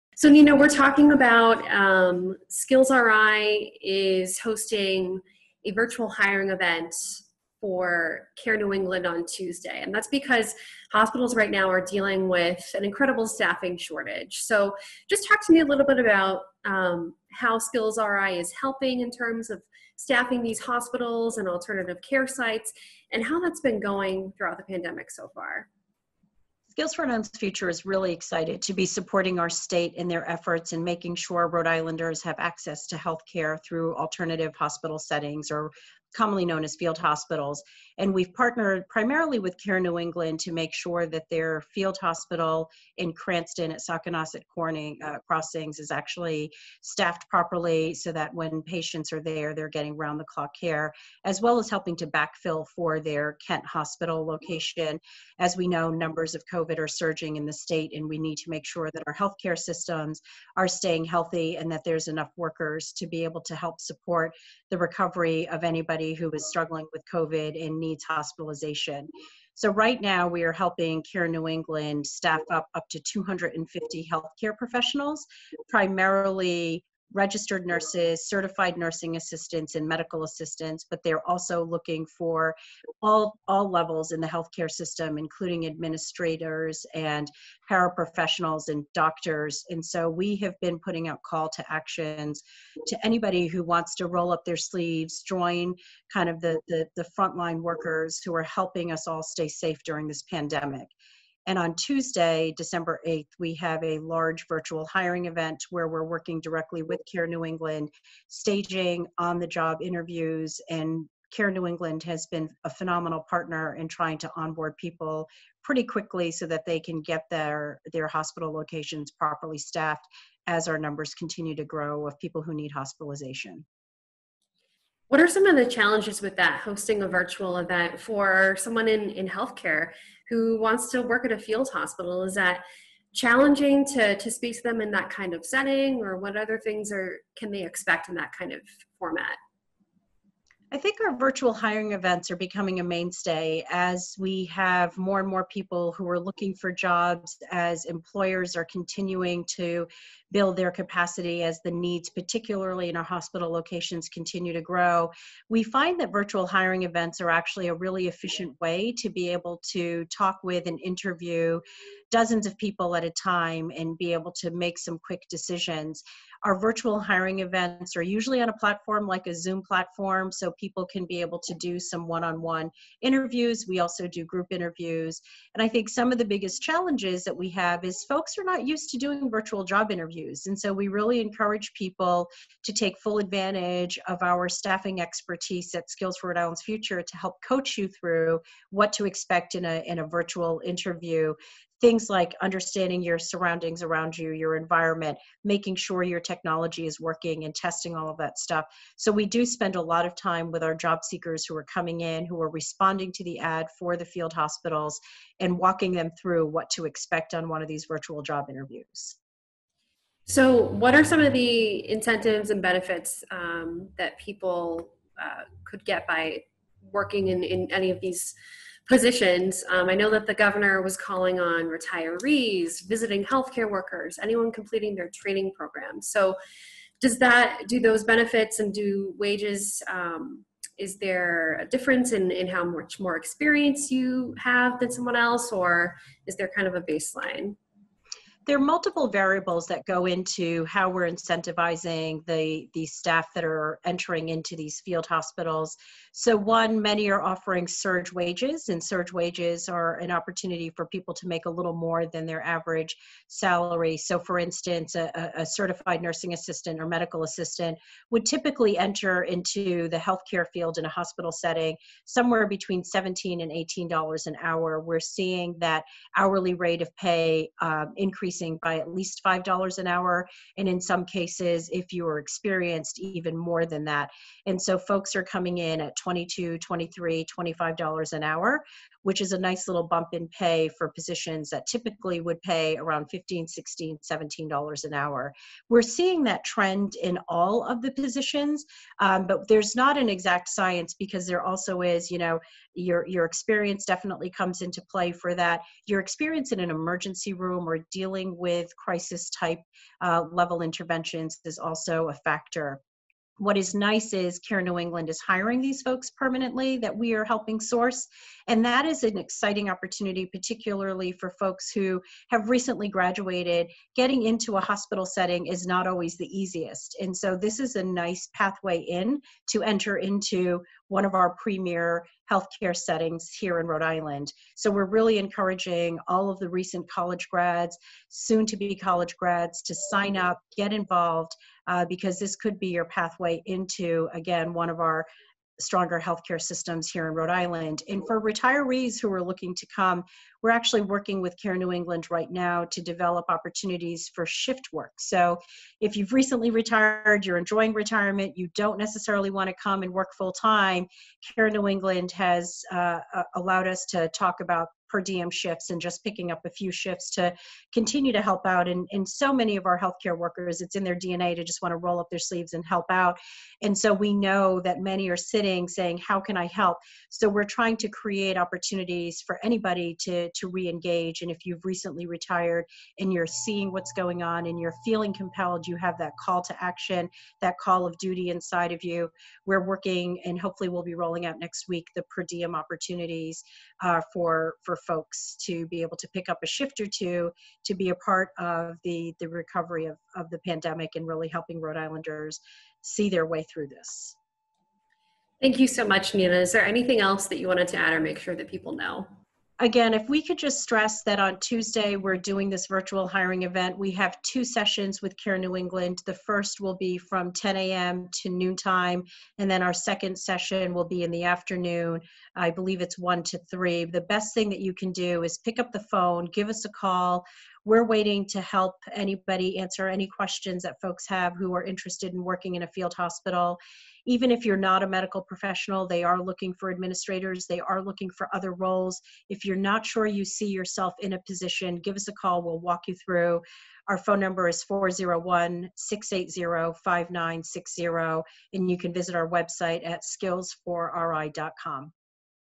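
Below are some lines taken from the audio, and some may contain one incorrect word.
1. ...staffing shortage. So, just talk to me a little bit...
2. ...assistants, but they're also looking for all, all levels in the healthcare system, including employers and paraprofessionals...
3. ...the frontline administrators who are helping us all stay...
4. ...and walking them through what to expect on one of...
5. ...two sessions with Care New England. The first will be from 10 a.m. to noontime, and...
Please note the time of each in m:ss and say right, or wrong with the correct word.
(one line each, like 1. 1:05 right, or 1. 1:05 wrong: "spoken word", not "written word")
1. 0:13 right
2. 1:20 wrong: "administrators", not "employers"
3. 1:36 wrong: "workers", not "administrators"
4. 3:25 right
5. 6:44 right.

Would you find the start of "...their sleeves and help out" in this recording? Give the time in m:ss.
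6:02.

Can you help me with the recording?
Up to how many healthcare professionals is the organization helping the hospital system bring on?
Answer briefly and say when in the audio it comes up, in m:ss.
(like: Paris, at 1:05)
250, at 1:13.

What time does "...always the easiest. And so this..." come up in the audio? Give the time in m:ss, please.
5:15.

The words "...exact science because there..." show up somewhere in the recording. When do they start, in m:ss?
4:50.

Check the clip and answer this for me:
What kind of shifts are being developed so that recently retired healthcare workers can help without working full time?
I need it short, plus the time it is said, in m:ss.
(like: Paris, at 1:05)
Per diem shifts, at 5:54.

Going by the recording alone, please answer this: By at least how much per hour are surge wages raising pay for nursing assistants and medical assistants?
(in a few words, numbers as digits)
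$5 an hour.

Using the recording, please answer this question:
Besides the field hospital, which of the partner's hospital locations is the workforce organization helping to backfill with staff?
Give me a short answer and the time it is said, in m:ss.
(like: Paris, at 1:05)
Kent Hospital, at 0:53.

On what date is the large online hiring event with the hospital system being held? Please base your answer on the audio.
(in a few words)
December 8th.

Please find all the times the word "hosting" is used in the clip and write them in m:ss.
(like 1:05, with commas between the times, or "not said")
0:04, 2:06.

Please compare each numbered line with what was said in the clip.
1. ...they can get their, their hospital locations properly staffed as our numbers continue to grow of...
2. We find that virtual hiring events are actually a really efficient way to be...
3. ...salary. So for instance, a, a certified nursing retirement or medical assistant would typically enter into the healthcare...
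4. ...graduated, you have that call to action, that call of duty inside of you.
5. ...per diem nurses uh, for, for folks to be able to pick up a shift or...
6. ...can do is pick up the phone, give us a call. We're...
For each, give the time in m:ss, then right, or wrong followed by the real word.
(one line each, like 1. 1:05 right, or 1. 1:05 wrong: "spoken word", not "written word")
1. 1:56 right
2. 2:35 right
3. 4:13 wrong: "assistant", not "retirement"
4. 6:15 wrong: "compelled", not "graduated"
5. 6:22 wrong: "opportunities", not "nurses"
6. 6:54 right.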